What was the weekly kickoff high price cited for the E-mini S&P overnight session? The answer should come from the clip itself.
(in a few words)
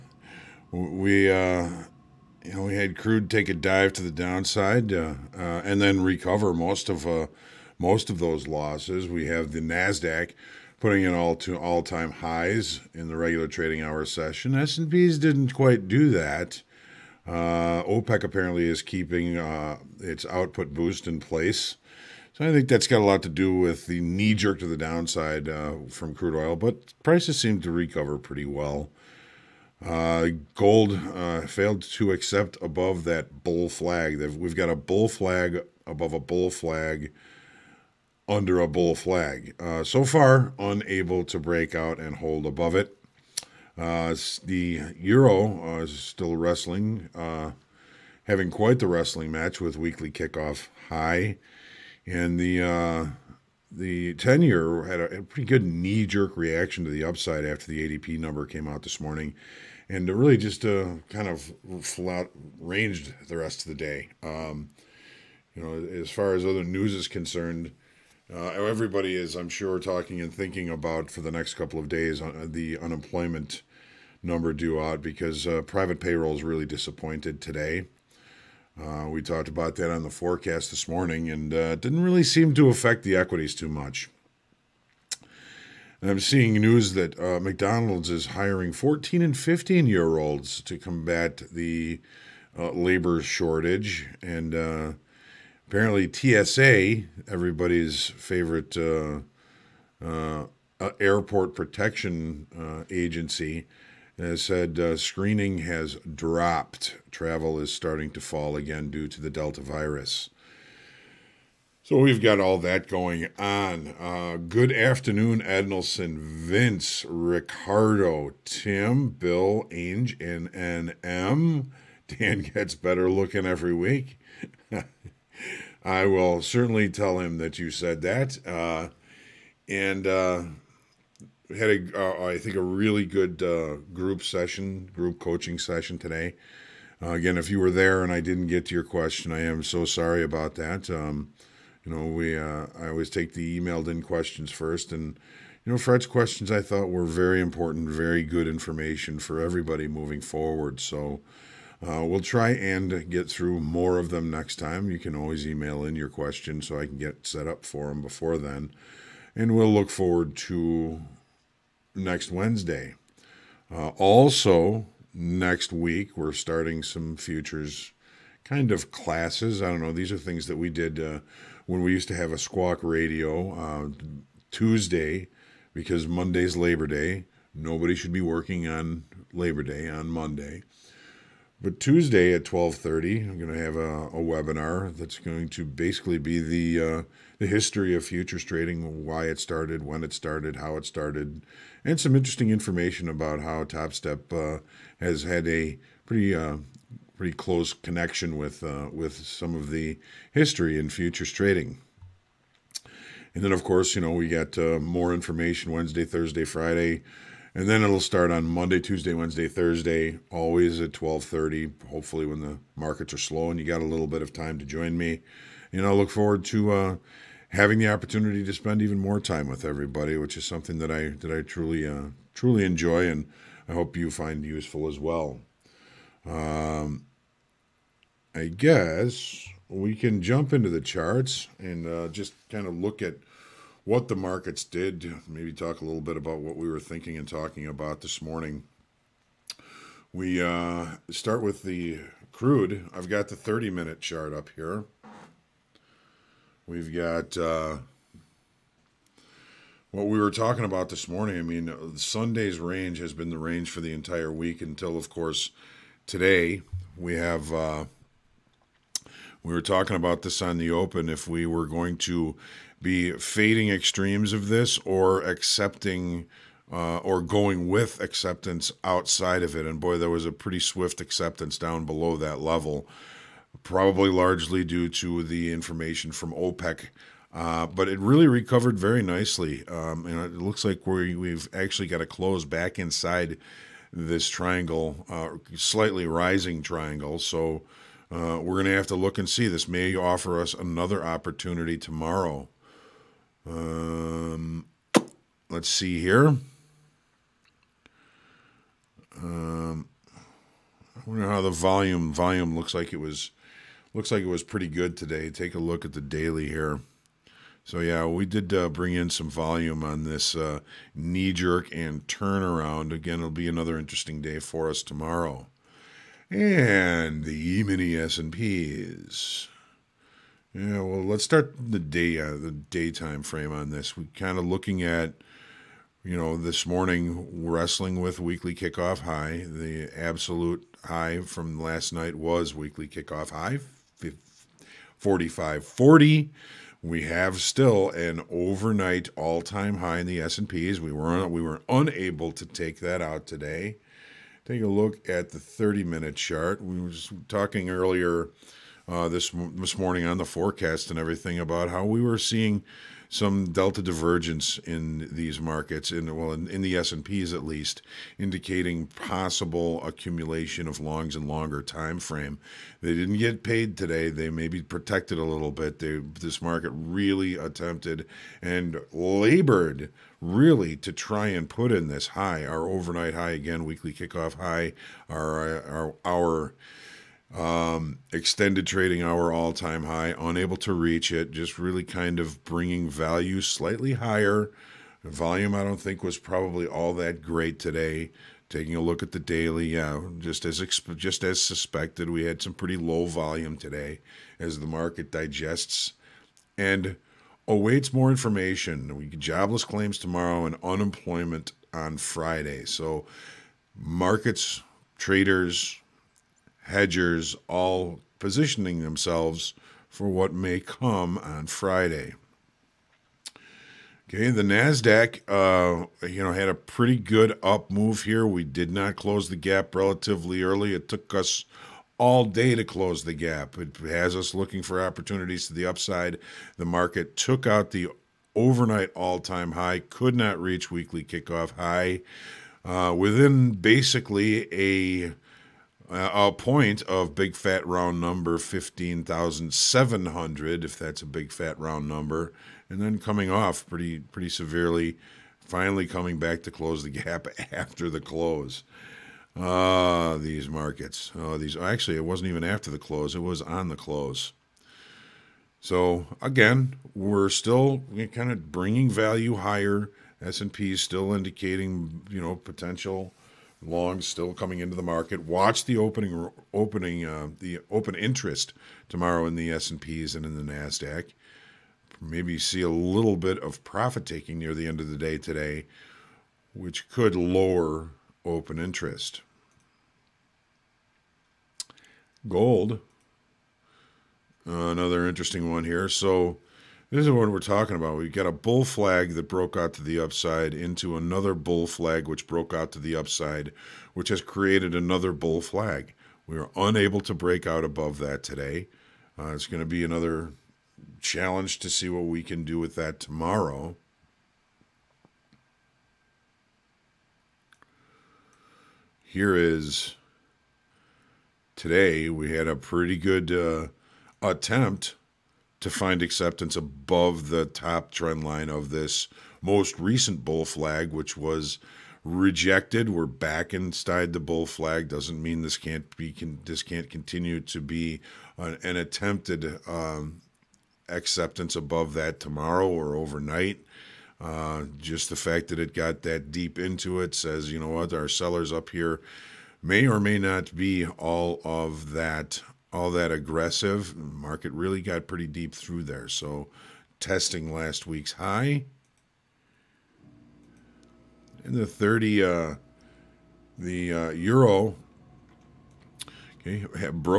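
45.40.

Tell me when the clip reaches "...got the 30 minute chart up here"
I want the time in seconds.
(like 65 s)
243 s.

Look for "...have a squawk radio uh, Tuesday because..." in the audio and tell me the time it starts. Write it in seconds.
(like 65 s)
172 s.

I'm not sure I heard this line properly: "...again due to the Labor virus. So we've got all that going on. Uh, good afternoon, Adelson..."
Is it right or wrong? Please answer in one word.
wrong.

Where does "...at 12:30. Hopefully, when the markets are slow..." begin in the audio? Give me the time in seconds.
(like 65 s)
210 s.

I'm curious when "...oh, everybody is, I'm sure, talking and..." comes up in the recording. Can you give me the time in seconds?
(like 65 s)
68 s.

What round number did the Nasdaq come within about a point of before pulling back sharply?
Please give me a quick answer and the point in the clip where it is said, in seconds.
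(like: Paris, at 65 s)
15,700, at 438 s.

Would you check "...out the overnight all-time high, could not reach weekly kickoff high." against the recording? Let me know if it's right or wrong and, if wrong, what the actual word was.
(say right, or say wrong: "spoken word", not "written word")
right.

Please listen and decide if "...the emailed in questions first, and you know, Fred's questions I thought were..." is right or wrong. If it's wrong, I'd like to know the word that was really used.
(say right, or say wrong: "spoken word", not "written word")
right.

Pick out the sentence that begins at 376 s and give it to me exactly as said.
our um, extended trading hour all time high, unable to reach it, just really kind of bringing value slightly higher.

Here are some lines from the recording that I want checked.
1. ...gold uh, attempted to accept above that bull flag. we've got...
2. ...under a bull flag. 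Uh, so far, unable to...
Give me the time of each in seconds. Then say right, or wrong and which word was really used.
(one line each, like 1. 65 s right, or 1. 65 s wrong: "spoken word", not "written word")
1. 30 s wrong: "failed", not "attempted"
2. 38 s right.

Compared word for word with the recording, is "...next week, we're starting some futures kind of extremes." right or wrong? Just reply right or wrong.
wrong.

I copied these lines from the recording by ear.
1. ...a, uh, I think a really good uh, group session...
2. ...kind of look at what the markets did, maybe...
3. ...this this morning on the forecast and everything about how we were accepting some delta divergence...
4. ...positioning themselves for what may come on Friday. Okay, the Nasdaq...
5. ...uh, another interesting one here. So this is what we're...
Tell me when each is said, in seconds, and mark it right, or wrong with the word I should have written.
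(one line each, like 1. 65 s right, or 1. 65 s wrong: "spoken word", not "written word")
1. 131 s right
2. 232 s right
3. 349 s wrong: "seeing", not "accepting"
4. 408 s right
5. 484 s right.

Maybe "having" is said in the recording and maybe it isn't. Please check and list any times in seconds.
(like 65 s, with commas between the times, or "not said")
48 s, 217 s.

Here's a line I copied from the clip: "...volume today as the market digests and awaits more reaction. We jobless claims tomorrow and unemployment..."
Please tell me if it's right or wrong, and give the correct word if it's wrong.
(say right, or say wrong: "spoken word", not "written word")
wrong: "information", not "reaction".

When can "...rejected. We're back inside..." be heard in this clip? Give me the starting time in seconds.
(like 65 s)
522 s.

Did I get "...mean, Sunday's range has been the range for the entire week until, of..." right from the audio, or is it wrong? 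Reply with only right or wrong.
right.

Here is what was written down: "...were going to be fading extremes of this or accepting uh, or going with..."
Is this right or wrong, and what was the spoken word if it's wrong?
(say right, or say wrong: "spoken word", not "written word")
right.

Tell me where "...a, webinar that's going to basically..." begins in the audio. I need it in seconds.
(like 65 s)
184 s.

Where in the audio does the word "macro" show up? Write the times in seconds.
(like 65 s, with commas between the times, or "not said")
not said.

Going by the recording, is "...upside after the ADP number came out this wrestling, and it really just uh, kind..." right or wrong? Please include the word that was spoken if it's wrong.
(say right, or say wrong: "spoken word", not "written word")
wrong: "morning", not "wrestling".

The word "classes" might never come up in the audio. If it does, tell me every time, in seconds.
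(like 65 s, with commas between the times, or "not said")
168 s.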